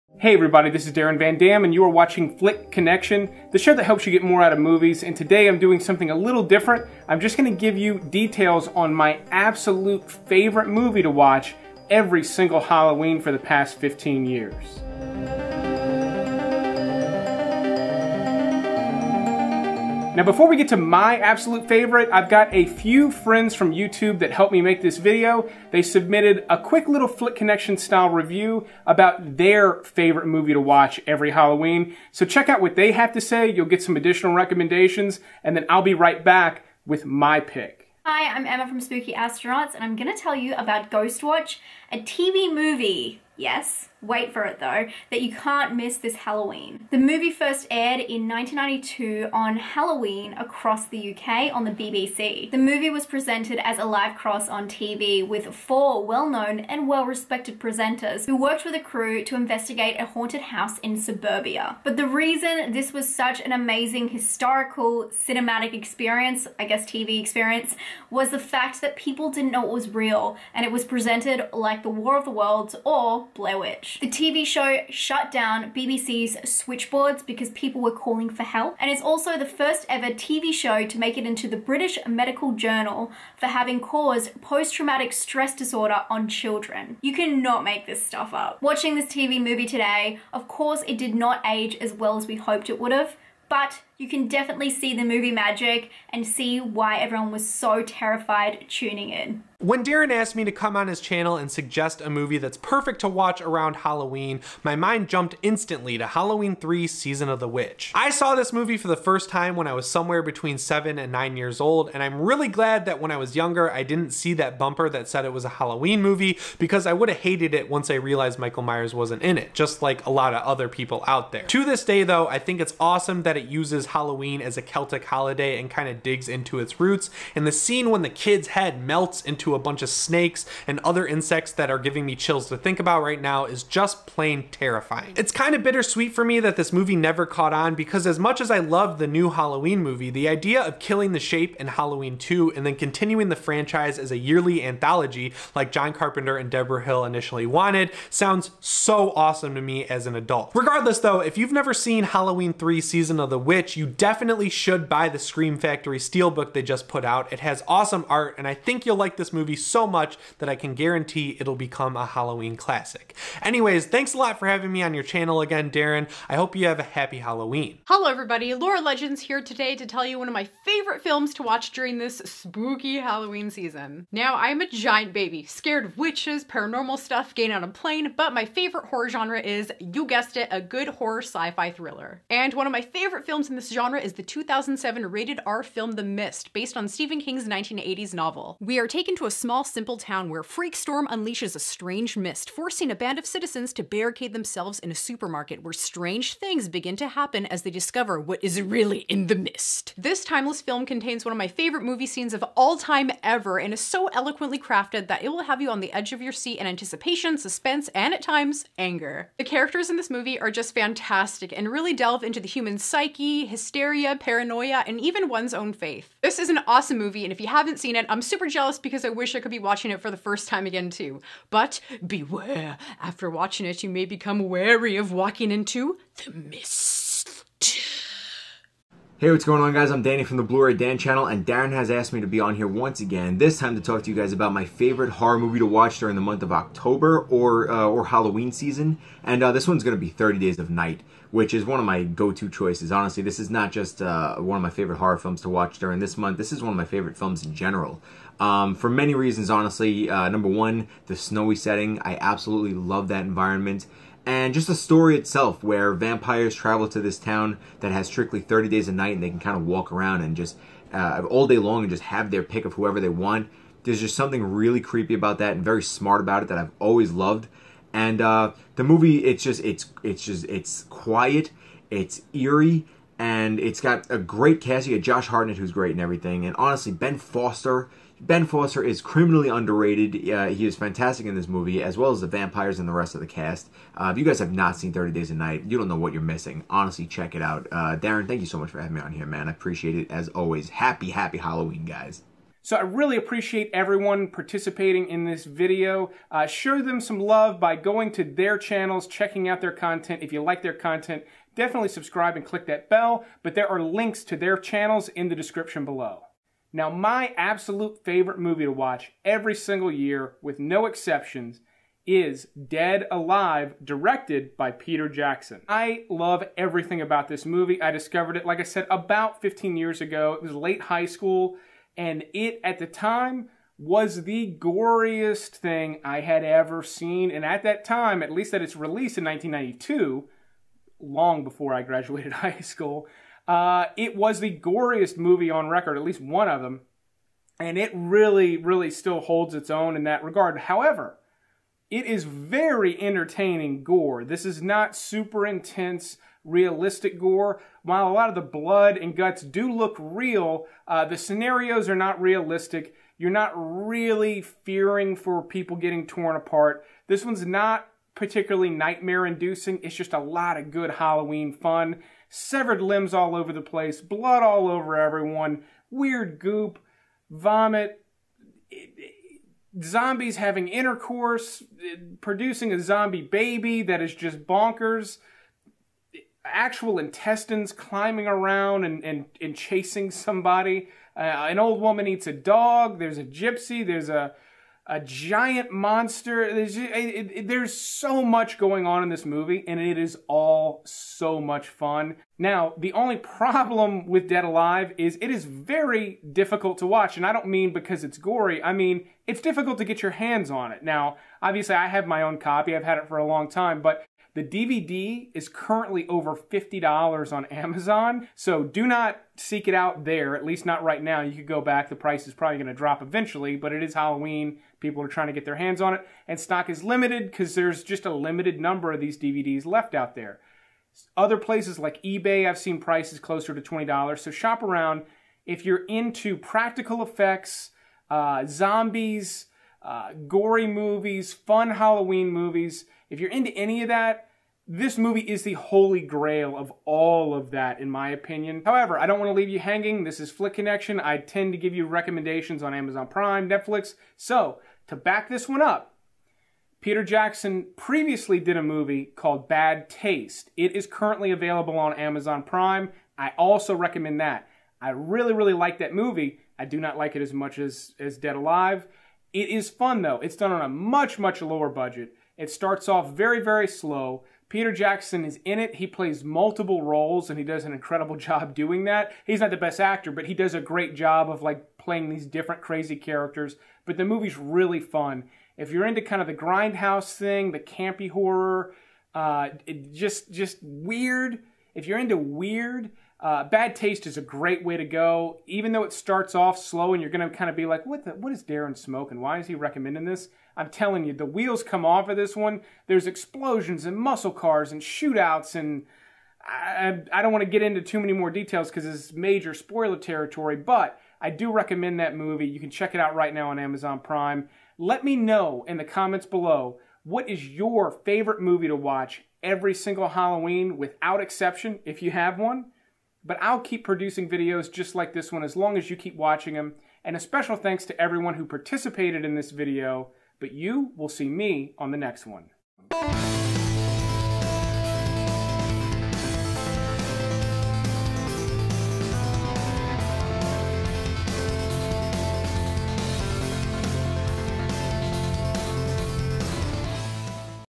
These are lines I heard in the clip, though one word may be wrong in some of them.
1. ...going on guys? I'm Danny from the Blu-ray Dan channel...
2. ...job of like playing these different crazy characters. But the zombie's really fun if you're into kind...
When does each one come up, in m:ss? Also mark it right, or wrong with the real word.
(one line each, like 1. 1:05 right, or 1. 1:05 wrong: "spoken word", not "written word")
1. 3:49 right
2. 7:50 wrong: "movie", not "zombie".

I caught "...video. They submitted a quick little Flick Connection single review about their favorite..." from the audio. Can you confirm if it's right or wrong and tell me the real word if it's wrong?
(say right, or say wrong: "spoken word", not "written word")
wrong: "style", not "single".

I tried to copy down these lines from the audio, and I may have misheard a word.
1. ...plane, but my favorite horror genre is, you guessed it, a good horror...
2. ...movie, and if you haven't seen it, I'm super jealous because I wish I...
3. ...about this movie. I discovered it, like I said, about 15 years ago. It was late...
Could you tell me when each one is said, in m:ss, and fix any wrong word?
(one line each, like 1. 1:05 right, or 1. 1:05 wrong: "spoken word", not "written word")
1. 2:57 right
2. 3:36 right
3. 5:17 right.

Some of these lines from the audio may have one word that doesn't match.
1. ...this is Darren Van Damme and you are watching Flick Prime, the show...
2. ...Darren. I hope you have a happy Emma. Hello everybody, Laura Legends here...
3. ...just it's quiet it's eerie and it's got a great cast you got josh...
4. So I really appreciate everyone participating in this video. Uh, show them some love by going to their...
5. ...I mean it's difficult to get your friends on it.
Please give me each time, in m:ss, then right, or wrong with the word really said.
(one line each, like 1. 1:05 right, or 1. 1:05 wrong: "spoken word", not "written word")
1. 0:00 wrong: "Connection", not "Prime"
2. 2:45 wrong: "Halloween", not "Emma"
3. 4:30 right
4. 4:52 right
5. 6:38 wrong: "hands", not "friends".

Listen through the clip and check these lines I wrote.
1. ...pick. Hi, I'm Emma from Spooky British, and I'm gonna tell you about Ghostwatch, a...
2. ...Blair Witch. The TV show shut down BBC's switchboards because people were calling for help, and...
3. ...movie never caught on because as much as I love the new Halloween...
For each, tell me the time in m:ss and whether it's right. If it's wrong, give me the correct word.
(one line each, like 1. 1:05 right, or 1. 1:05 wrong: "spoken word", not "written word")
1. 0:37 wrong: "Astronauts", not "British"
2. 1:13 right
3. 2:16 right.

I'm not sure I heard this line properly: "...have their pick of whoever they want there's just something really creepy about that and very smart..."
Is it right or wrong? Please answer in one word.
right.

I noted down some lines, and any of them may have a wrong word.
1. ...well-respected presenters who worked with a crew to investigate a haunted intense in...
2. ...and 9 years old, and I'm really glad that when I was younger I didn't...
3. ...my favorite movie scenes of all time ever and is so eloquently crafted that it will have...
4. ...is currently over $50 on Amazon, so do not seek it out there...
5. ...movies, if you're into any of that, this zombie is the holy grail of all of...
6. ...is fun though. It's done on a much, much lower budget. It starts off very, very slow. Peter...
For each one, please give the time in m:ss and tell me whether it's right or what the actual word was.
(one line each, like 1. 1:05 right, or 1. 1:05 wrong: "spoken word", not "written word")
1. 0:56 wrong: "house", not "intense"
2. 1:50 right
3. 3:21 right
4. 6:45 right
5. 7:12 wrong: "movie", not "zombie"
6. 7:39 right.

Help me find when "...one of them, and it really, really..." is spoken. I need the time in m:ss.
5:36.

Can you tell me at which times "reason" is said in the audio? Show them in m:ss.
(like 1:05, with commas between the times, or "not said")
1:02, 4:09.